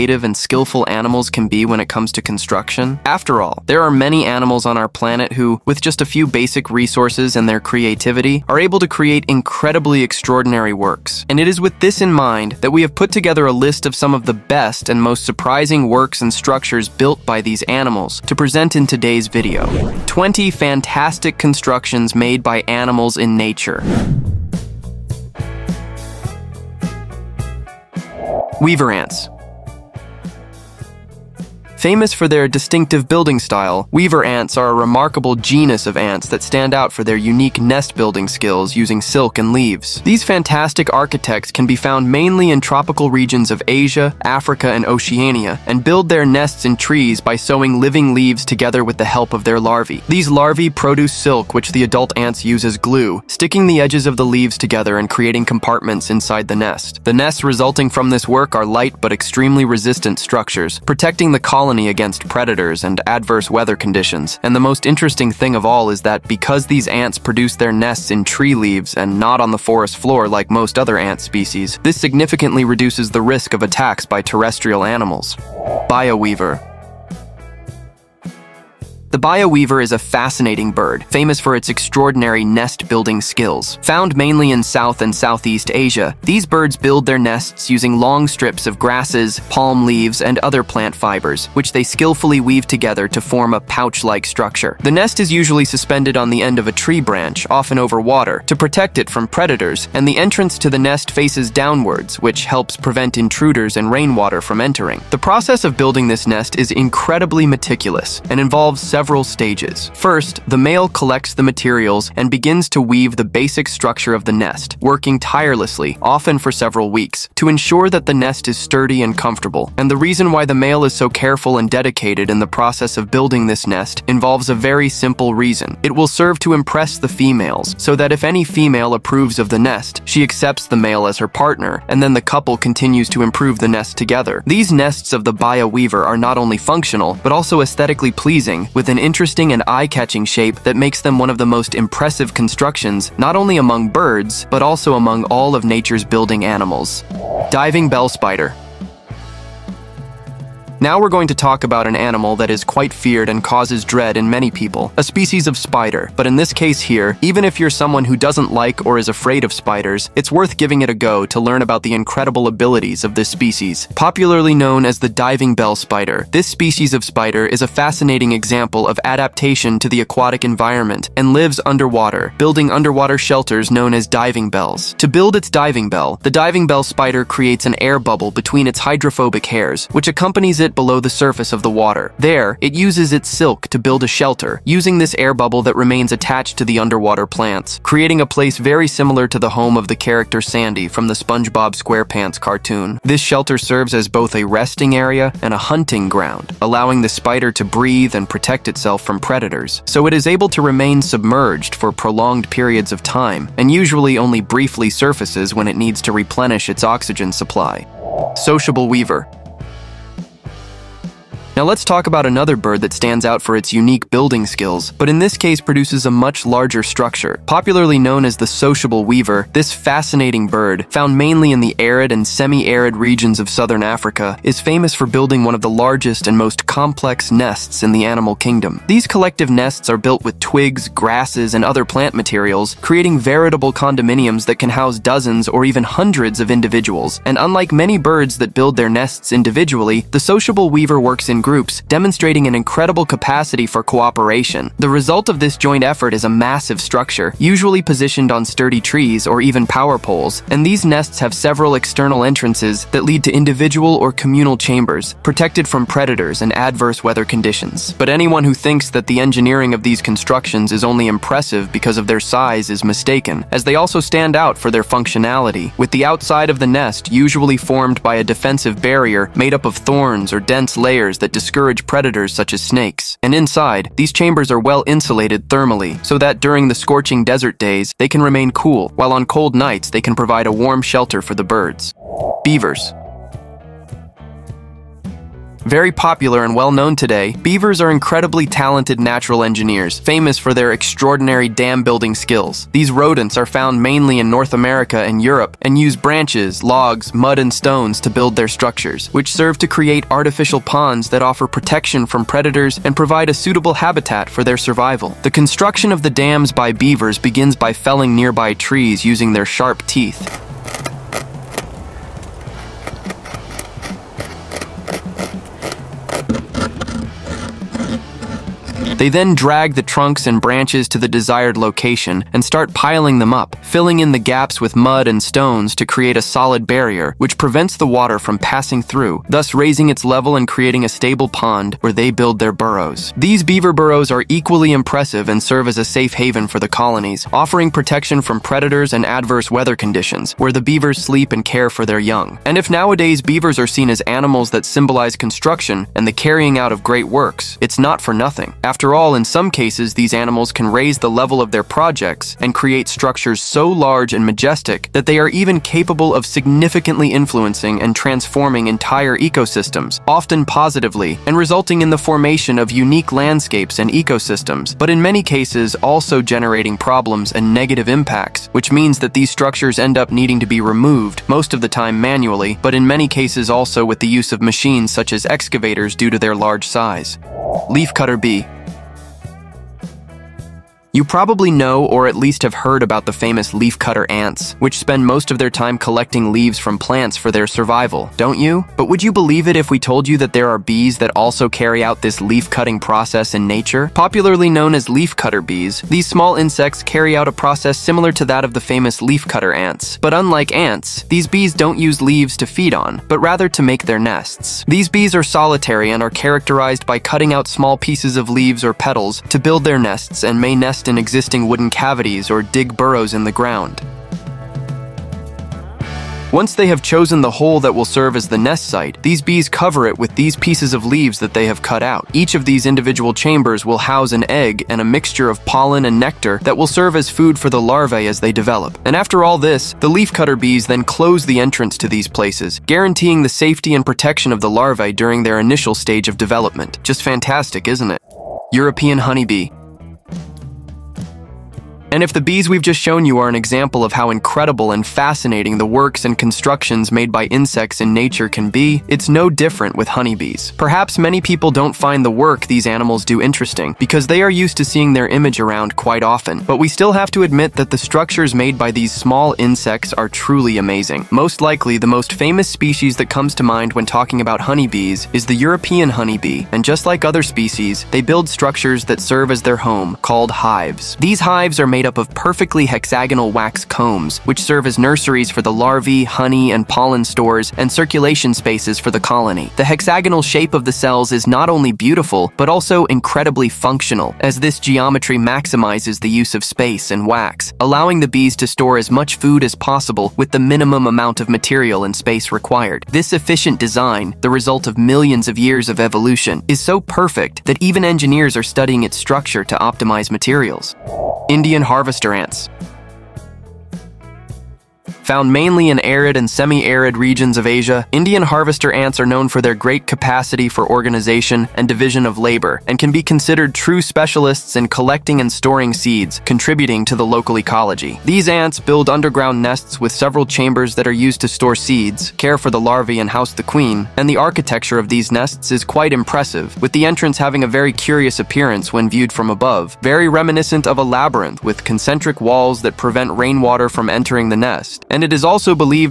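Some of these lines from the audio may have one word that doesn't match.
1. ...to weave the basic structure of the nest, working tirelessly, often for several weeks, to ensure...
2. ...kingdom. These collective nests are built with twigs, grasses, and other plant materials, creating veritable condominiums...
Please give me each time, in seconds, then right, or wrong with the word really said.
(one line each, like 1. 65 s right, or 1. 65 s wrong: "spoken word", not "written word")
1. 112 s right
2. 228 s right.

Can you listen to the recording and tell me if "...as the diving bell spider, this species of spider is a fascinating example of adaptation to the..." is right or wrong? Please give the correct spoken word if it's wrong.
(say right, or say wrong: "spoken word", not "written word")
right.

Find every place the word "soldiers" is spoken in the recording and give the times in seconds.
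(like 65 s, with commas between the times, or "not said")
not said.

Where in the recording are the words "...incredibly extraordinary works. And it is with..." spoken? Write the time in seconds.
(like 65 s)
9 s.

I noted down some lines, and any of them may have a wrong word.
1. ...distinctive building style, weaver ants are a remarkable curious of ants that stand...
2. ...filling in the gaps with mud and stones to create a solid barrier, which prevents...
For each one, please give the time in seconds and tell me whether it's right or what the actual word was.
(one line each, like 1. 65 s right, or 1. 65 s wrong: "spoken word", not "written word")
1. 32 s wrong: "genus", not "curious"
2. 323 s right.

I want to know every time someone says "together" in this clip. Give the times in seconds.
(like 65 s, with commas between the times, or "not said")
13 s, 48 s, 54 s, 92 s, 133 s.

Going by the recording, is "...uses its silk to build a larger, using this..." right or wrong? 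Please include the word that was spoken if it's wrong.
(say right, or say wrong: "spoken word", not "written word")
wrong: "shelter", not "larger".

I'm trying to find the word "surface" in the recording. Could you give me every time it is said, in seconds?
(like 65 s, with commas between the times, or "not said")
181 s, 204 s.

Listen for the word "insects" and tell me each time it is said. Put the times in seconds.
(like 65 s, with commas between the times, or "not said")
396 s, 447 s, 459 s.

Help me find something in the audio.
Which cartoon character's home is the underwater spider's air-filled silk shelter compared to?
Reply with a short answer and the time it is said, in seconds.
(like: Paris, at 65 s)
Sandy, at 189 s.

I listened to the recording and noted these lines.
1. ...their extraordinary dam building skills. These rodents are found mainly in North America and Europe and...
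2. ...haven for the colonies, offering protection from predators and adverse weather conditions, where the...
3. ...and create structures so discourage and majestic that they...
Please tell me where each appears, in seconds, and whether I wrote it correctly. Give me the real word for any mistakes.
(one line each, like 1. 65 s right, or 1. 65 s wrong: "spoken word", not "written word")
1. 290 s right
2. 336 s right
3. 352 s wrong: "large", not "discourage".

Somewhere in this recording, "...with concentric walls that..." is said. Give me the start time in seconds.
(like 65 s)
531 s.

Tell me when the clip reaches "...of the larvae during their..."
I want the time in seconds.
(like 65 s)
434 s.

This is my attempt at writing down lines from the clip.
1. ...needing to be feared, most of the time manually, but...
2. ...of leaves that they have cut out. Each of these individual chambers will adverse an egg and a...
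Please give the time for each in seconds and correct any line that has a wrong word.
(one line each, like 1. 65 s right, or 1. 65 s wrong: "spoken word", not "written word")
1. 370 s wrong: "removed", not "feared"
2. 420 s wrong: "house", not "adverse".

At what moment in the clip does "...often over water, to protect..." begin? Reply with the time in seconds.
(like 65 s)
97 s.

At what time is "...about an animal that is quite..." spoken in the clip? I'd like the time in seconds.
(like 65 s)
151 s.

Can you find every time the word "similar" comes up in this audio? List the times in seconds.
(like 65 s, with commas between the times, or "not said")
188 s, 397 s.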